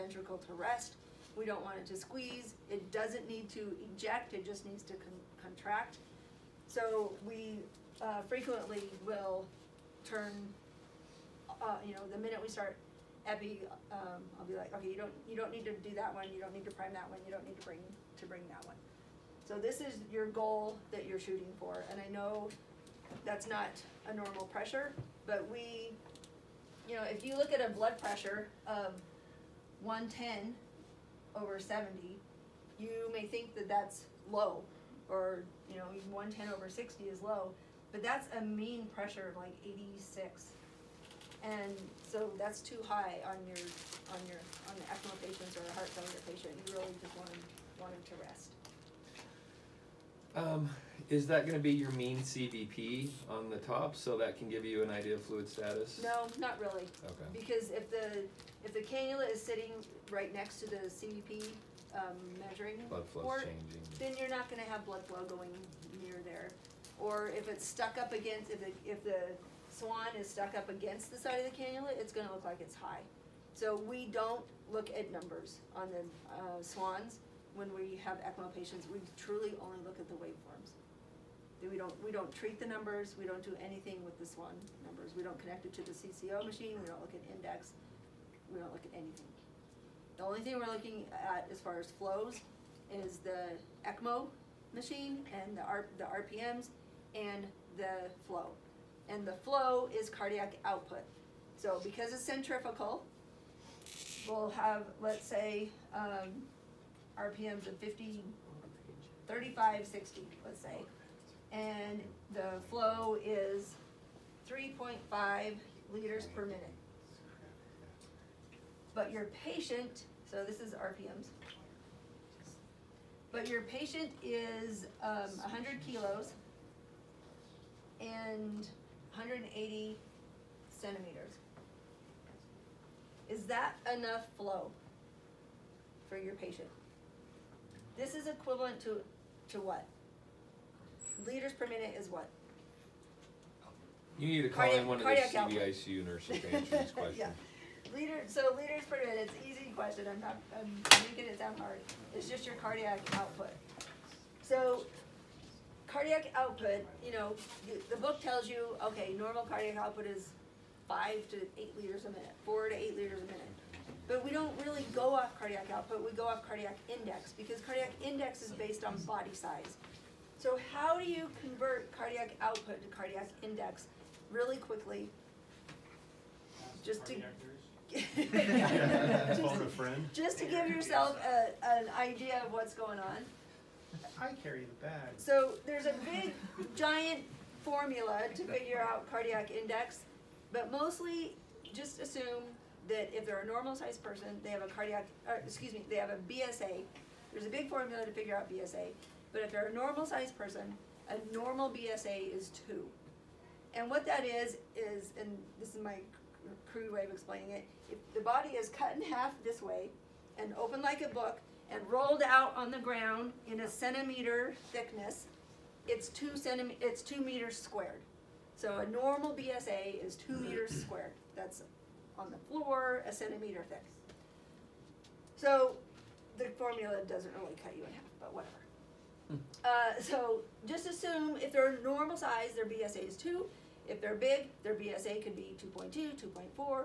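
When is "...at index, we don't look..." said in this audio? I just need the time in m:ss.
1:27.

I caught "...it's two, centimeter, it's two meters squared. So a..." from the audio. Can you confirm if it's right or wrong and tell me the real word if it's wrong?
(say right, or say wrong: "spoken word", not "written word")
right.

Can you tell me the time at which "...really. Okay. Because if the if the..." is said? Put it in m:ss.
0:56.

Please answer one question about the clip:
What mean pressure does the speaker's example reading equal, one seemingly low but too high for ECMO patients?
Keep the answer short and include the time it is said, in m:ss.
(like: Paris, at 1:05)
86, at 0:39.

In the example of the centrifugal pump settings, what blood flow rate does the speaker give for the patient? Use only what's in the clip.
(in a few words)
3.5 liters per minute.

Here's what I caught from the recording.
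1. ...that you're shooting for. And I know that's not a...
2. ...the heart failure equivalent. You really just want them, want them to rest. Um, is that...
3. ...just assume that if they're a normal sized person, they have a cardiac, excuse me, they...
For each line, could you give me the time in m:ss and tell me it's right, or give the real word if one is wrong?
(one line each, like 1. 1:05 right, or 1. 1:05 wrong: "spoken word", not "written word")
1. 0:20 right
2. 0:45 wrong: "patient", not "equivalent"
3. 3:11 right.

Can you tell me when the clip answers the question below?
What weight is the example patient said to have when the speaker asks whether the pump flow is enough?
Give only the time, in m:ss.
2:05.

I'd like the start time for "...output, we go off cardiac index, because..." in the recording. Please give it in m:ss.
2:45.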